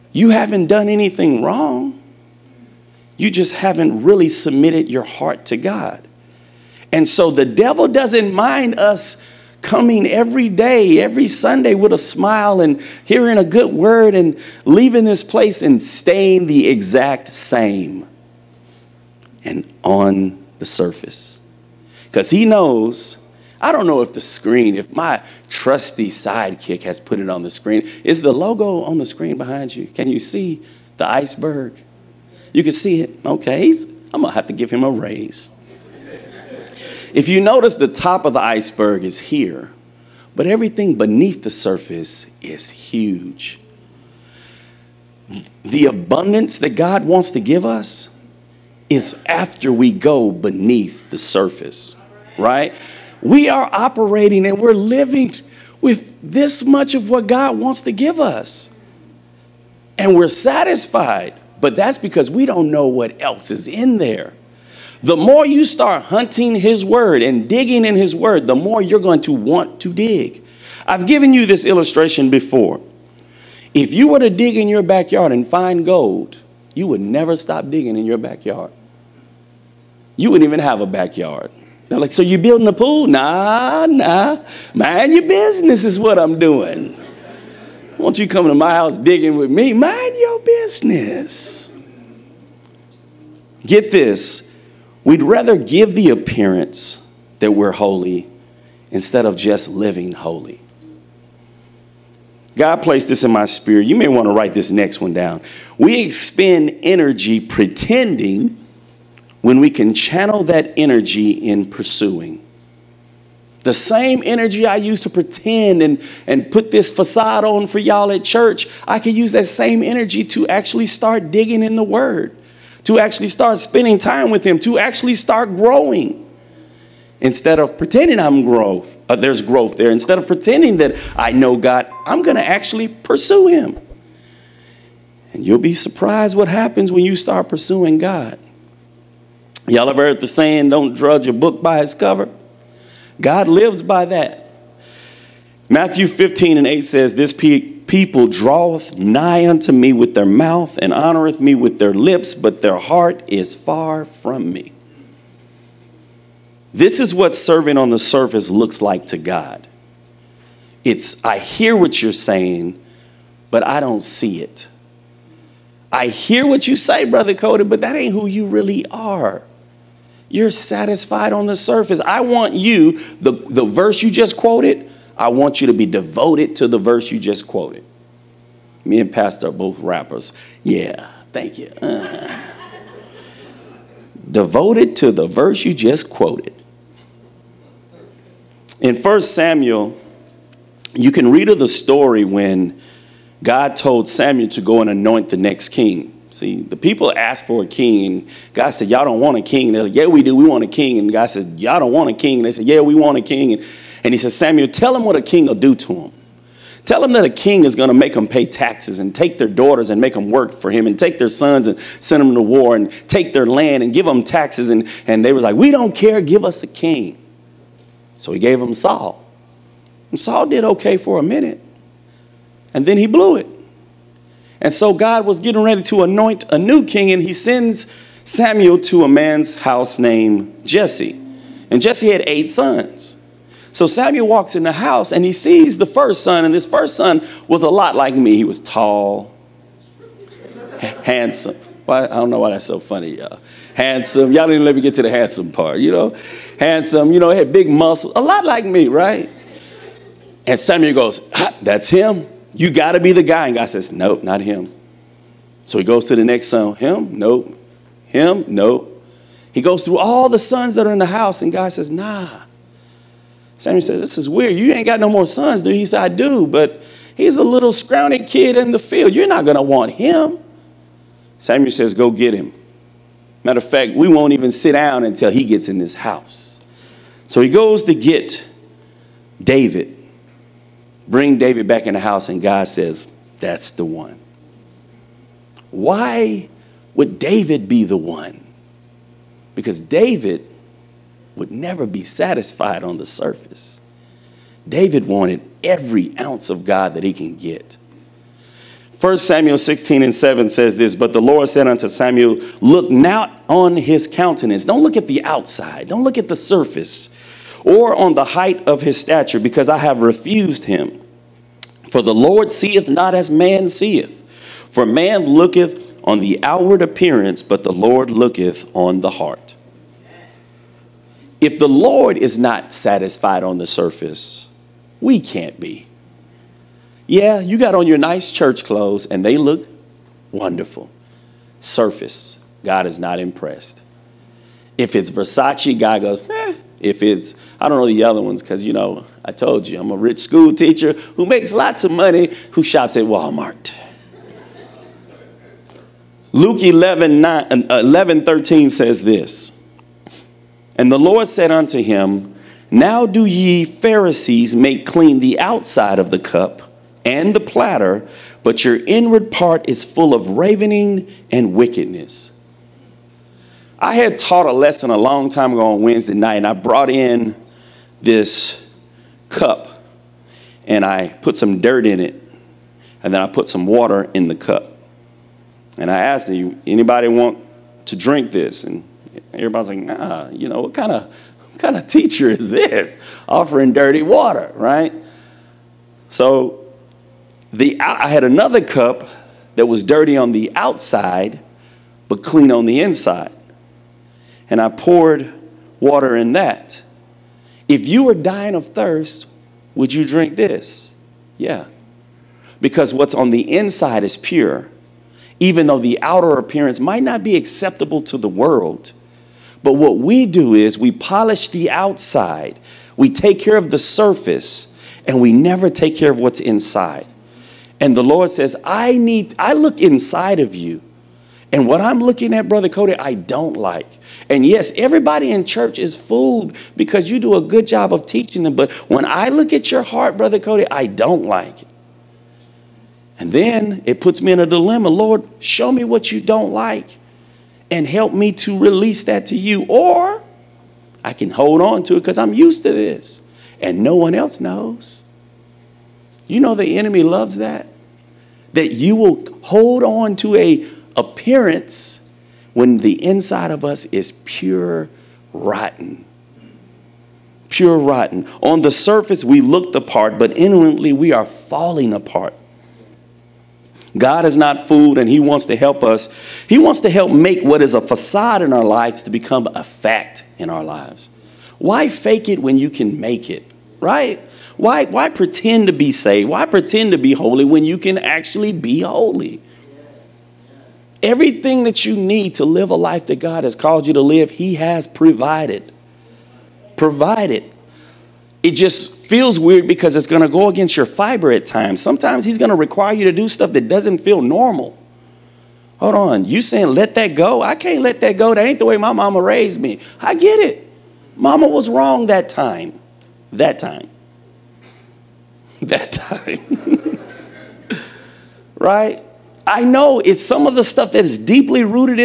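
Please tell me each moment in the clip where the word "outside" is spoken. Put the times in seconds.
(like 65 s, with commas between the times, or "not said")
305 s, 355 s, 390 s, 411 s.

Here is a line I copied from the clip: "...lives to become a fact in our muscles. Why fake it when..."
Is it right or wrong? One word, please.
wrong.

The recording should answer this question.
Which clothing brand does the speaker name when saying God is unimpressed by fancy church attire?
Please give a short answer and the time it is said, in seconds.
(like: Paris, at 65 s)
Versace, at 335 s.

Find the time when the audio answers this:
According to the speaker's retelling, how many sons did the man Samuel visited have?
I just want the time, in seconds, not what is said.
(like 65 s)
232 s.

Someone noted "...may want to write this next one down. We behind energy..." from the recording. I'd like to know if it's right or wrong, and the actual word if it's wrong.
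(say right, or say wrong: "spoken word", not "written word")
wrong: "expend", not "behind".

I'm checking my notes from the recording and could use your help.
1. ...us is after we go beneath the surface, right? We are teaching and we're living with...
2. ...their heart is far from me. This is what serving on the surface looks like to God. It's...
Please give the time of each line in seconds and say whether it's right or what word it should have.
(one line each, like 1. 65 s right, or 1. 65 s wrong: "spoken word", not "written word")
1. 47 s wrong: "operating", not "teaching"
2. 152 s right.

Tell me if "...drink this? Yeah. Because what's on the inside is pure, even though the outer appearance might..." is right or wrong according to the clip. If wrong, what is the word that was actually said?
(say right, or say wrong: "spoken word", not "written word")
right.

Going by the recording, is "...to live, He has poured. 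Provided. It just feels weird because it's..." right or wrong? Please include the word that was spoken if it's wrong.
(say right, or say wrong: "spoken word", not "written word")
wrong: "provided", not "poured".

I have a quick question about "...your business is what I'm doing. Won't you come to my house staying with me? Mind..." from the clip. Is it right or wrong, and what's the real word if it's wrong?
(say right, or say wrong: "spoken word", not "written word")
wrong: "digging", not "staying".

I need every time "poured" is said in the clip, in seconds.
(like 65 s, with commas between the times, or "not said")
394 s.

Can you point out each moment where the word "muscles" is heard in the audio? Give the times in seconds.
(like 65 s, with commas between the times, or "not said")
247 s.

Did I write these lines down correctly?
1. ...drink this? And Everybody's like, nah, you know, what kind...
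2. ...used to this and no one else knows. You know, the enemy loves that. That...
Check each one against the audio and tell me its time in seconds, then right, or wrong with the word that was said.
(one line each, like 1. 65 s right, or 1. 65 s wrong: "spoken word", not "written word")
1. 377 s right
2. 442 s right.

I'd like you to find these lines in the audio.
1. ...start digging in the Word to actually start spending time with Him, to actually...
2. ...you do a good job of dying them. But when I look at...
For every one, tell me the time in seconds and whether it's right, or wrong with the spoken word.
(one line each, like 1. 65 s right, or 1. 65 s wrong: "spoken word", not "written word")
1. 120 s right
2. 427 s wrong: "teaching", not "dying".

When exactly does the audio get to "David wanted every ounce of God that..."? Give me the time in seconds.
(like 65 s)
294 s.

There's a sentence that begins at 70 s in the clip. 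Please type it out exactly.
I've given you this illustration before.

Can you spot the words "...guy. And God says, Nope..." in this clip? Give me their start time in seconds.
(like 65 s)
253 s.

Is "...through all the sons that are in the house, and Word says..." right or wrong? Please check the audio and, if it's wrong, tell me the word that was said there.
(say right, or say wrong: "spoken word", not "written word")
wrong: "God", not "Word".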